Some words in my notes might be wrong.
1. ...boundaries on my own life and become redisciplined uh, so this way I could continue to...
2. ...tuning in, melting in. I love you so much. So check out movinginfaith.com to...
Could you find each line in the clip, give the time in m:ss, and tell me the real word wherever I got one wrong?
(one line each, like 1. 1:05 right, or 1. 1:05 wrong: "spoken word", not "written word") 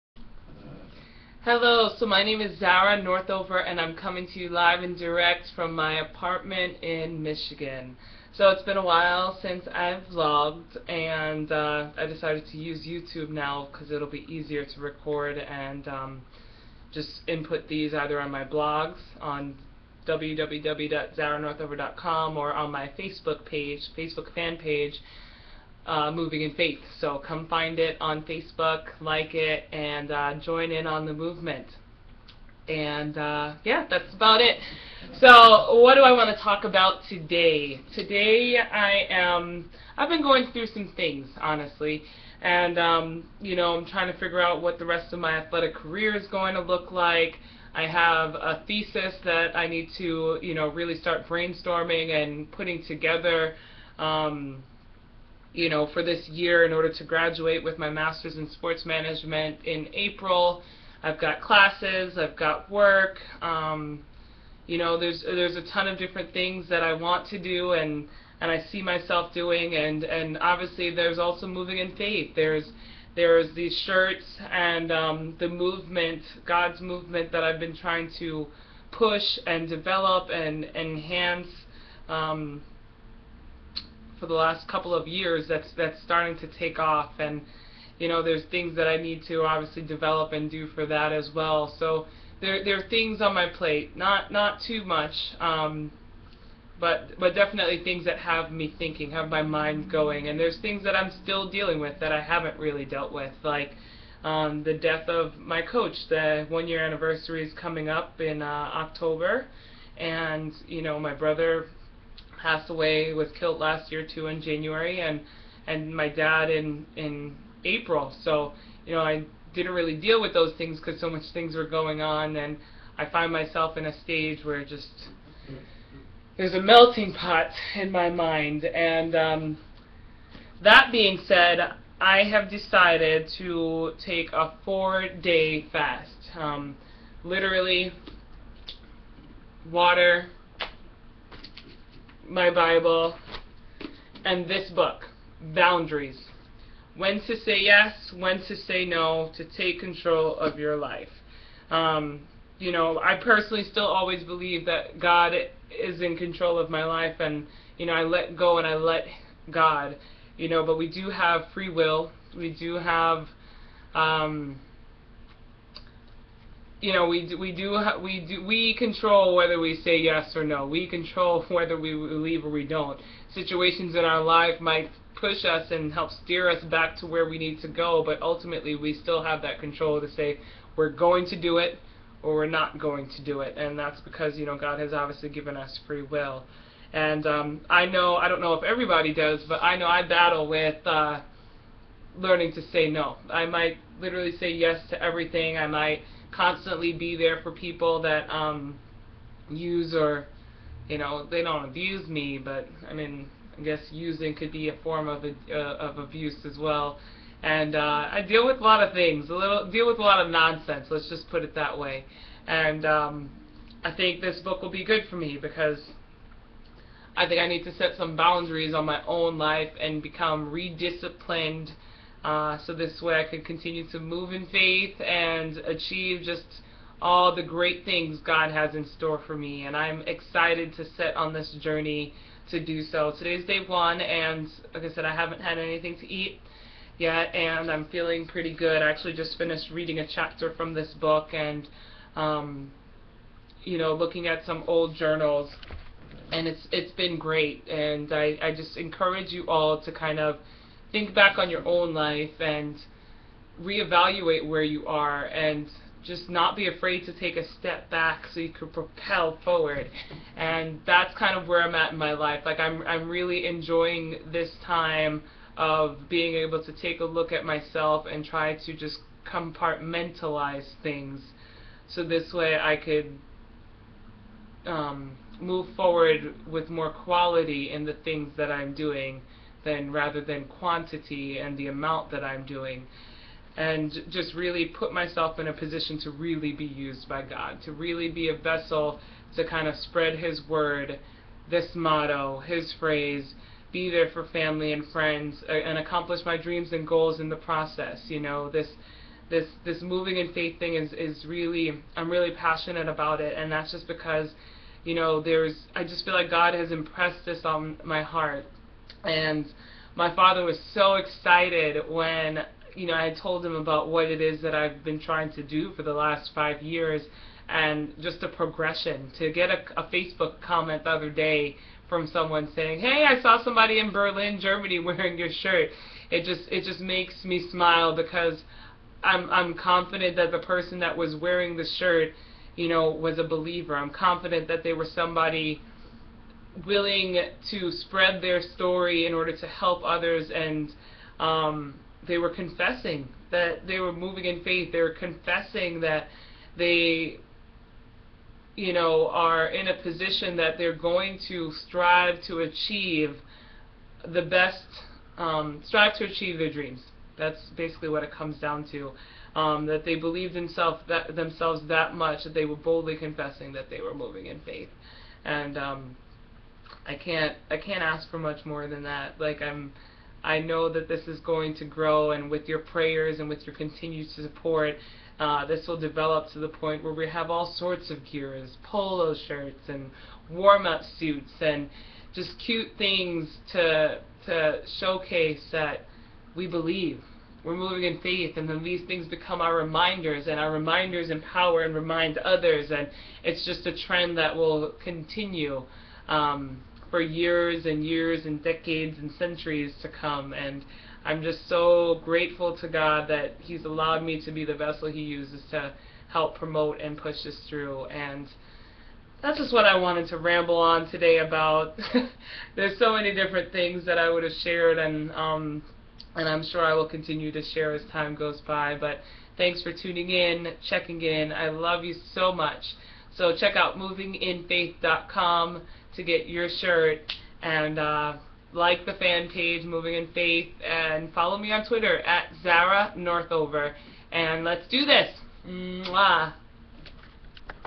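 1. 3:38 right
2. 6:59 wrong: "checking", not "melting".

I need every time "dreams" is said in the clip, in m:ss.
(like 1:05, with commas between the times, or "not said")
4:56, 5:56.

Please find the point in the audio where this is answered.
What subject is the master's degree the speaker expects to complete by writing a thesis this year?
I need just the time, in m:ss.
0:58.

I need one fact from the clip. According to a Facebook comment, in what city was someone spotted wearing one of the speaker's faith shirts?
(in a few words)
Berlin.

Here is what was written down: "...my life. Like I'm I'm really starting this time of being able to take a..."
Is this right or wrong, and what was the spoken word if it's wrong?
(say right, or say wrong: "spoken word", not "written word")
wrong: "enjoying", not "starting".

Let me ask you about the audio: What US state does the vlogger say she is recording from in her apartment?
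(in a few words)
Michigan.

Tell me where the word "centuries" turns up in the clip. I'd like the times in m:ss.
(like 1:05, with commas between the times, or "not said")
6:39.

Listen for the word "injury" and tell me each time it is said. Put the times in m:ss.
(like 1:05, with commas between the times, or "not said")
not said.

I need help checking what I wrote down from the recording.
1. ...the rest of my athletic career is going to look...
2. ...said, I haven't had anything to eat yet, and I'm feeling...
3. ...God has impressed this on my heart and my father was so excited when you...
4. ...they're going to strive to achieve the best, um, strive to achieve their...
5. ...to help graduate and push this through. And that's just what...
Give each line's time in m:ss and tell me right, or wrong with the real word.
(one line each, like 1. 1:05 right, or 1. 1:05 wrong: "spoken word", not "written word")
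1. 0:44 right
2. 3:54 right
3. 5:06 right
4. 5:50 right
5. 6:45 wrong: "promote", not "graduate".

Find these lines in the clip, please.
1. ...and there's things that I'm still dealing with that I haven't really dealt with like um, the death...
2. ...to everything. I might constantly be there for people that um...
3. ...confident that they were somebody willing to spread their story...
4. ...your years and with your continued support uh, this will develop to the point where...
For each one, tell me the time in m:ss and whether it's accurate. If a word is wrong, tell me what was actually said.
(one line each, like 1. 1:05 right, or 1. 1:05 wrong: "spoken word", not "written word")
1. 1:40 right
2. 3:14 right
3. 5:33 right
4. 6:12 wrong: "prayers", not "years".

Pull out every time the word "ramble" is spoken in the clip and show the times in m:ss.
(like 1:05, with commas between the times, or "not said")
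6:50.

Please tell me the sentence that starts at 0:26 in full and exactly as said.
So come find it on Facebook, like it, and uh, join in on the movement.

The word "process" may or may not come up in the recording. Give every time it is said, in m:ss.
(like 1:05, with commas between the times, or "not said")
4:57.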